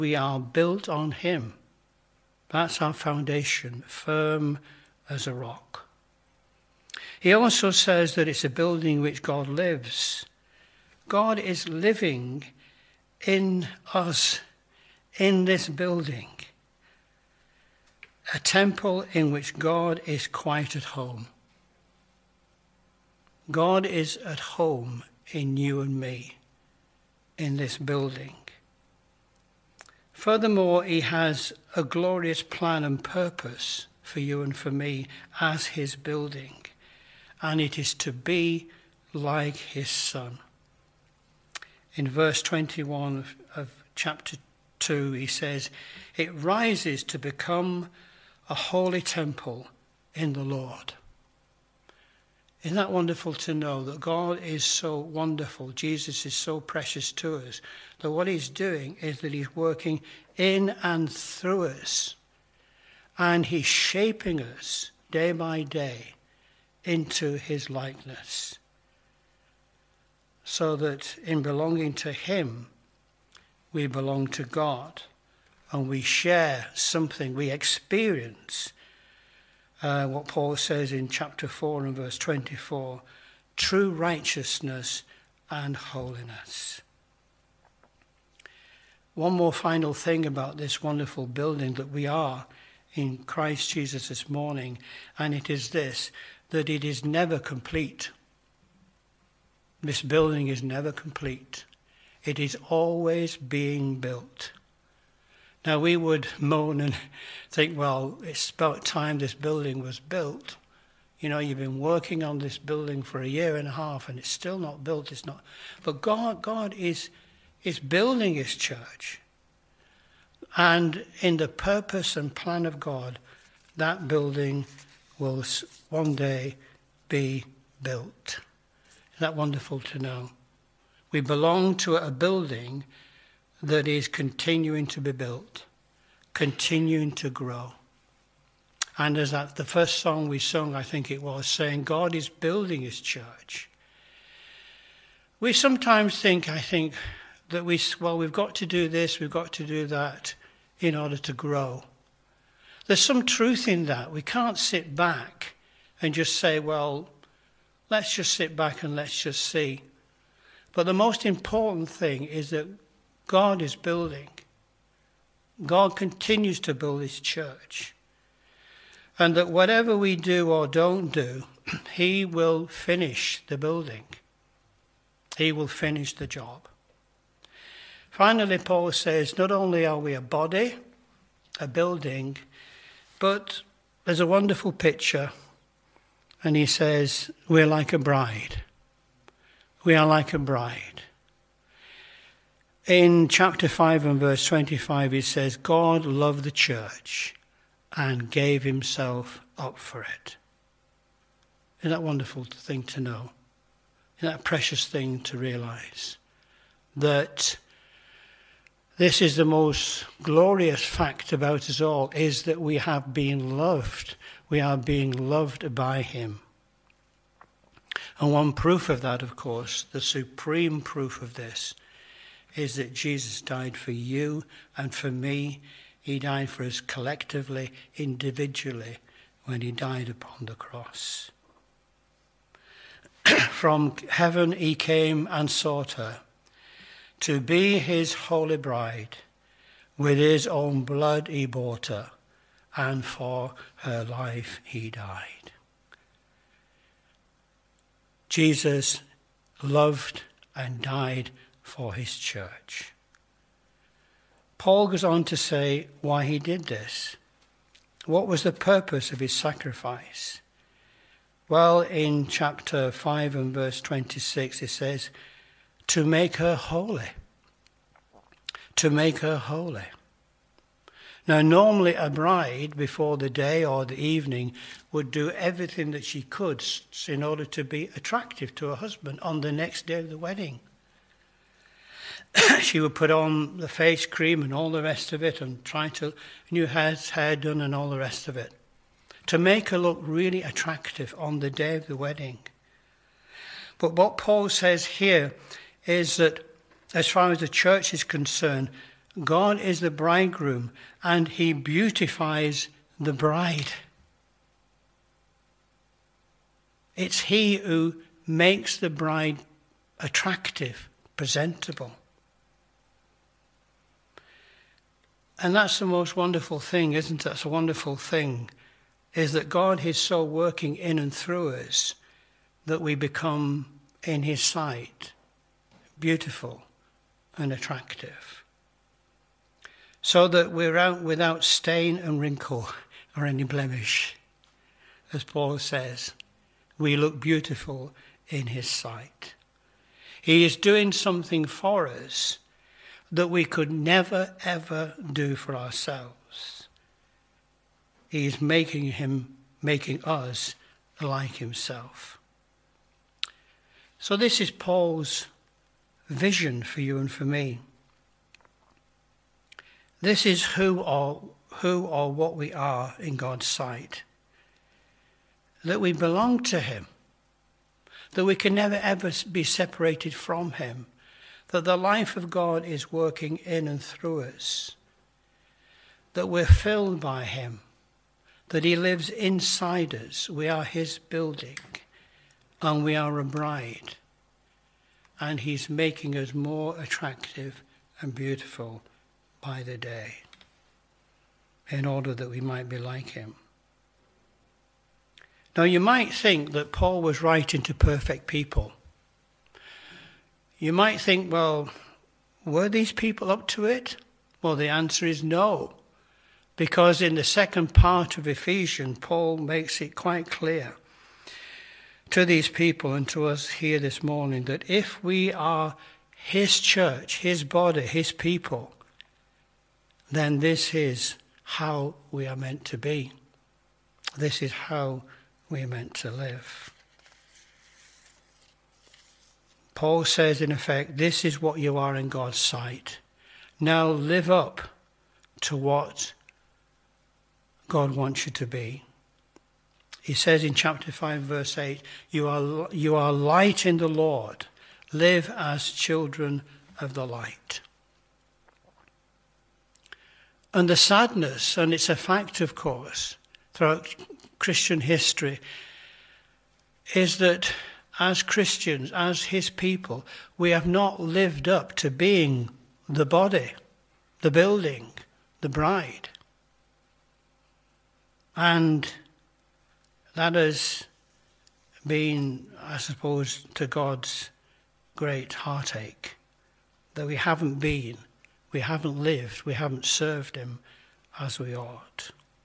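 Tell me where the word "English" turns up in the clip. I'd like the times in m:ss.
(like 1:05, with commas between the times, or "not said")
not said.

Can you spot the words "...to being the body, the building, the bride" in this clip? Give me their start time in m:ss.
7:41.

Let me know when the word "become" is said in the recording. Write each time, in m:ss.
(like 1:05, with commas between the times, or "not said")
0:47, 5:22.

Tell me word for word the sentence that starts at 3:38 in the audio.
And one proof of that, of course, the supreme proof of this, is that Jesus died for you and for me.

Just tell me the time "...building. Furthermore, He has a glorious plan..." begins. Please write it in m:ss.
0:27.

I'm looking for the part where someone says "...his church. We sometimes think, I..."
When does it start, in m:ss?
2:22.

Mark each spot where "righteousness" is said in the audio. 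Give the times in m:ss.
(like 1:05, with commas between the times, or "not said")
1:23.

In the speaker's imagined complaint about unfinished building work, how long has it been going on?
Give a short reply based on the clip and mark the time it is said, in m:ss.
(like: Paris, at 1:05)
a year and a half, at 1:53.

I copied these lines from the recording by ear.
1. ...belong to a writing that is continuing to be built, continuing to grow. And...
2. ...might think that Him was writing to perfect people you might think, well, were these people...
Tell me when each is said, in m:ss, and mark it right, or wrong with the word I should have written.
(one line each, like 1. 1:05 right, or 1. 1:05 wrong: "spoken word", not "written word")
1. 2:11 wrong: "building", not "writing"
2. 6:35 wrong: "Paul", not "Him".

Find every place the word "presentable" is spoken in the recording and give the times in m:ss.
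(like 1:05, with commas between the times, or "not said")
5:11.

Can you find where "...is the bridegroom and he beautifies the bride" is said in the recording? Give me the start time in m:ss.
4:59.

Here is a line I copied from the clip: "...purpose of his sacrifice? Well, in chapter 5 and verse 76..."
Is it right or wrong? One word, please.
wrong.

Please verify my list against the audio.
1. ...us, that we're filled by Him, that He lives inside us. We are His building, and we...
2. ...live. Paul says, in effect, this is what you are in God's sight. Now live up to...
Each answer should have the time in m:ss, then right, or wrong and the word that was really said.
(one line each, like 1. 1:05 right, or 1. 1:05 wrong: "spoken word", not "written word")
1. 6:14 right
2. 7:06 right.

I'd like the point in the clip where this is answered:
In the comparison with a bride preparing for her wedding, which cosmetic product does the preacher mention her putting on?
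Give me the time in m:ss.
4:43.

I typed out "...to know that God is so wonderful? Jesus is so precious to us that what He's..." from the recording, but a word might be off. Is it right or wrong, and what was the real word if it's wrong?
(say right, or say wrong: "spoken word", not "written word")
right.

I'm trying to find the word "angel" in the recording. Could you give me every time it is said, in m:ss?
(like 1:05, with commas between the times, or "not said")
not said.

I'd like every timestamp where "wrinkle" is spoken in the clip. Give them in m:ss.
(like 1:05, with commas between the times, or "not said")
5:32.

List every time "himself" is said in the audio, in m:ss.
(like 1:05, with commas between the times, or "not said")
3:18, 5:51.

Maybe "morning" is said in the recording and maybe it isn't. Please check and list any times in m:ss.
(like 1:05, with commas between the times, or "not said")
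1:34, 6:54.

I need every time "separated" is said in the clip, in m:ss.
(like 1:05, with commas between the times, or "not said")
6:09.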